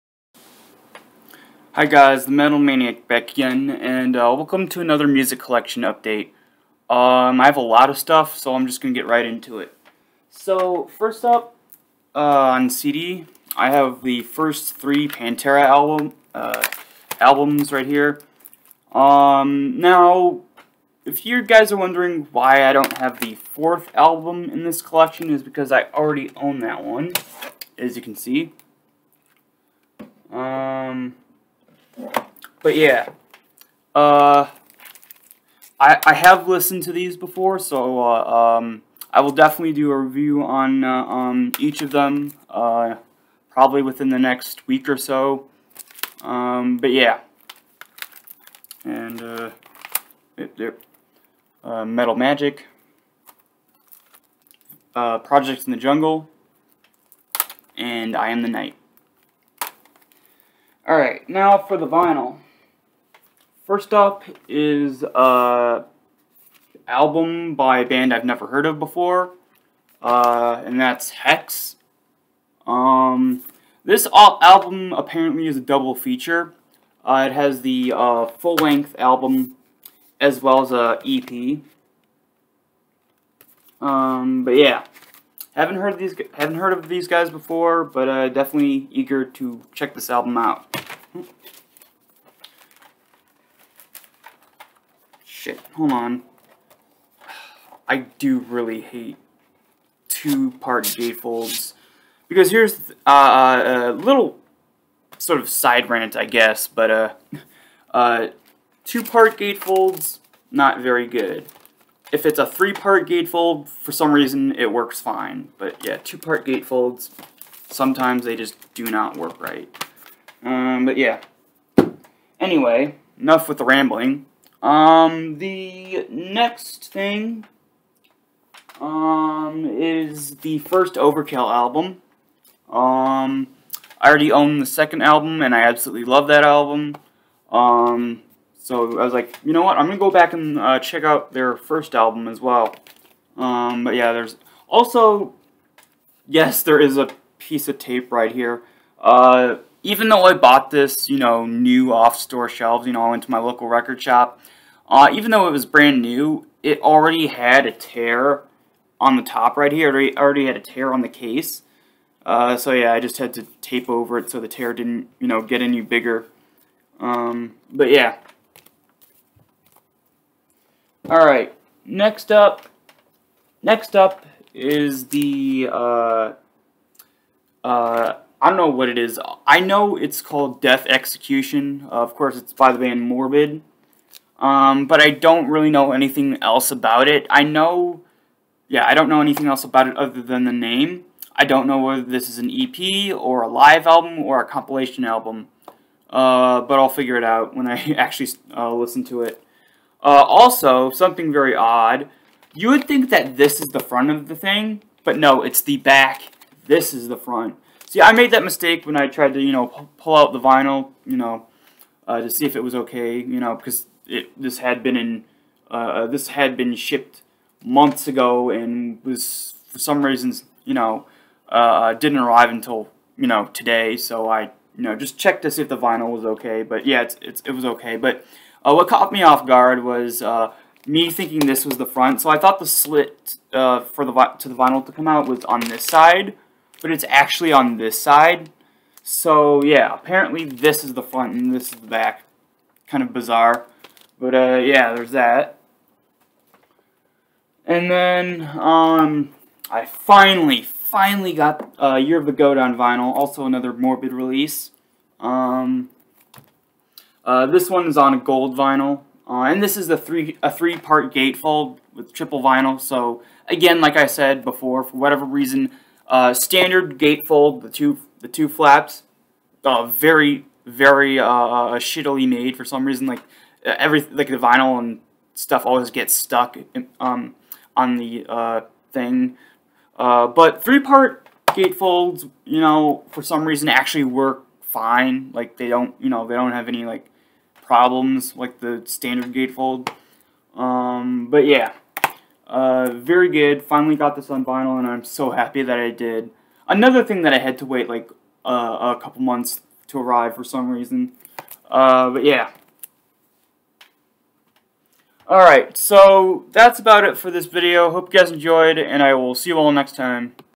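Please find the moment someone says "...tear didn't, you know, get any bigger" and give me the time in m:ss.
2:44.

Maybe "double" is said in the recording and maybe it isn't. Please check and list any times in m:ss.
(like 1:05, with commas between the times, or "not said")
1:15.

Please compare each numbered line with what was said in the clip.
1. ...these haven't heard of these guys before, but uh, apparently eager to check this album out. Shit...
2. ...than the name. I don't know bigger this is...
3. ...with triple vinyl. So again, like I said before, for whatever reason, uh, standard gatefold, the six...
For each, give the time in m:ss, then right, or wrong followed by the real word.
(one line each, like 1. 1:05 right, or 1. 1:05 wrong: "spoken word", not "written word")
1. 1:25 wrong: "definitely", not "apparently"
2. 3:10 wrong: "whether", not "bigger"
3. 4:21 wrong: "two", not "six".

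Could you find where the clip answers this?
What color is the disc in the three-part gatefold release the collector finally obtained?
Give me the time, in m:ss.
4:18.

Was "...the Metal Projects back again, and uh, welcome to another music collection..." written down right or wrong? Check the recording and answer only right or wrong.
wrong.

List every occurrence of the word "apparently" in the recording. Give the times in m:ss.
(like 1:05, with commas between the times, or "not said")
1:14, 3:59.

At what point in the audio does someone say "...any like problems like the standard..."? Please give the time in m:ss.
4:46.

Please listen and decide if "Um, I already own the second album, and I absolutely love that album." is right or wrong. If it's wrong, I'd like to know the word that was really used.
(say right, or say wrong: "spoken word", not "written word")
right.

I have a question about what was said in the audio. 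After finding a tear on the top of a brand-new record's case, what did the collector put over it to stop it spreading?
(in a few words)
A piece of tape.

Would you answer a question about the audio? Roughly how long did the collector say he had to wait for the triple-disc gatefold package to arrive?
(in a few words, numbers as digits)
A couple months.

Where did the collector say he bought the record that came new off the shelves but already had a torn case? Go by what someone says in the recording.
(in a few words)
Local record shop.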